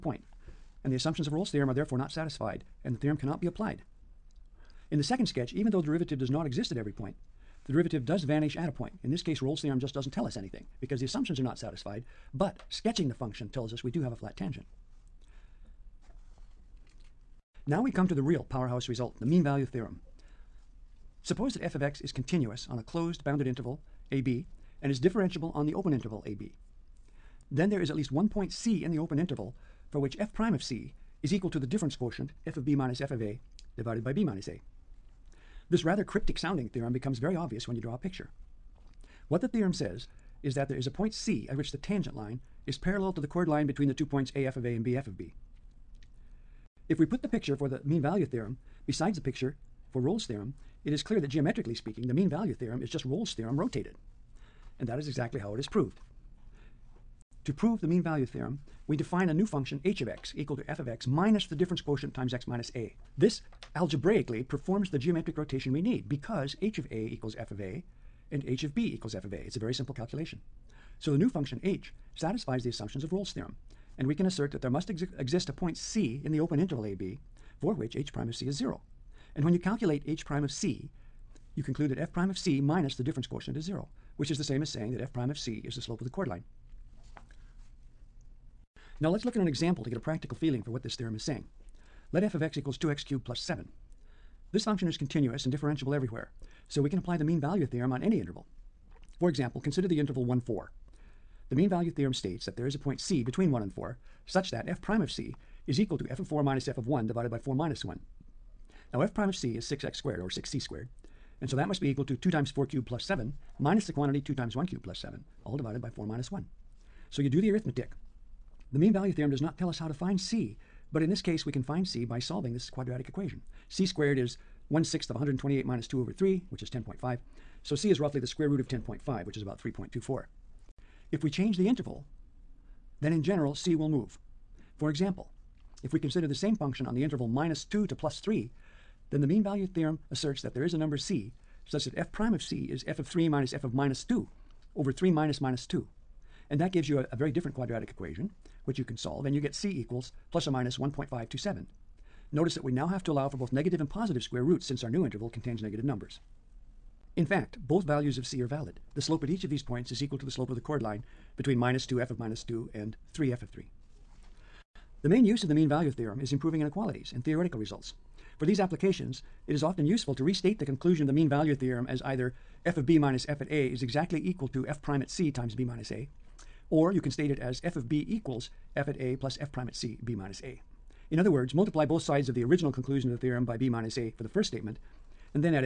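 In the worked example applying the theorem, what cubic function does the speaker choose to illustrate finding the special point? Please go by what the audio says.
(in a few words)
2x^3 + 7.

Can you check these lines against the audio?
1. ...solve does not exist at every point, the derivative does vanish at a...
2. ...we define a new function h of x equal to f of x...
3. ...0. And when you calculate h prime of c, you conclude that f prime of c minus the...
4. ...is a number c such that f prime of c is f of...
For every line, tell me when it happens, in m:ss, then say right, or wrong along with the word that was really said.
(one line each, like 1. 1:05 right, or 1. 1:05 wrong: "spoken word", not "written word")
1. 0:05 wrong: "derivative", not "solve"
2. 0:58 right
3. 1:18 right
4. 2:20 right.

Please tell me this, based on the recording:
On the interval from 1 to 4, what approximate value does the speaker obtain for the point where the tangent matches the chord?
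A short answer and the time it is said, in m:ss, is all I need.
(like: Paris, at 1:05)
3.24, at 2:09.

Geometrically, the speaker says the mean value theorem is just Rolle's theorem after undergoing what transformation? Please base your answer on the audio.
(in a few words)
rotated.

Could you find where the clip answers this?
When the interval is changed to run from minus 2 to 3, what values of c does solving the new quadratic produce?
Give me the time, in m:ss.
2:30.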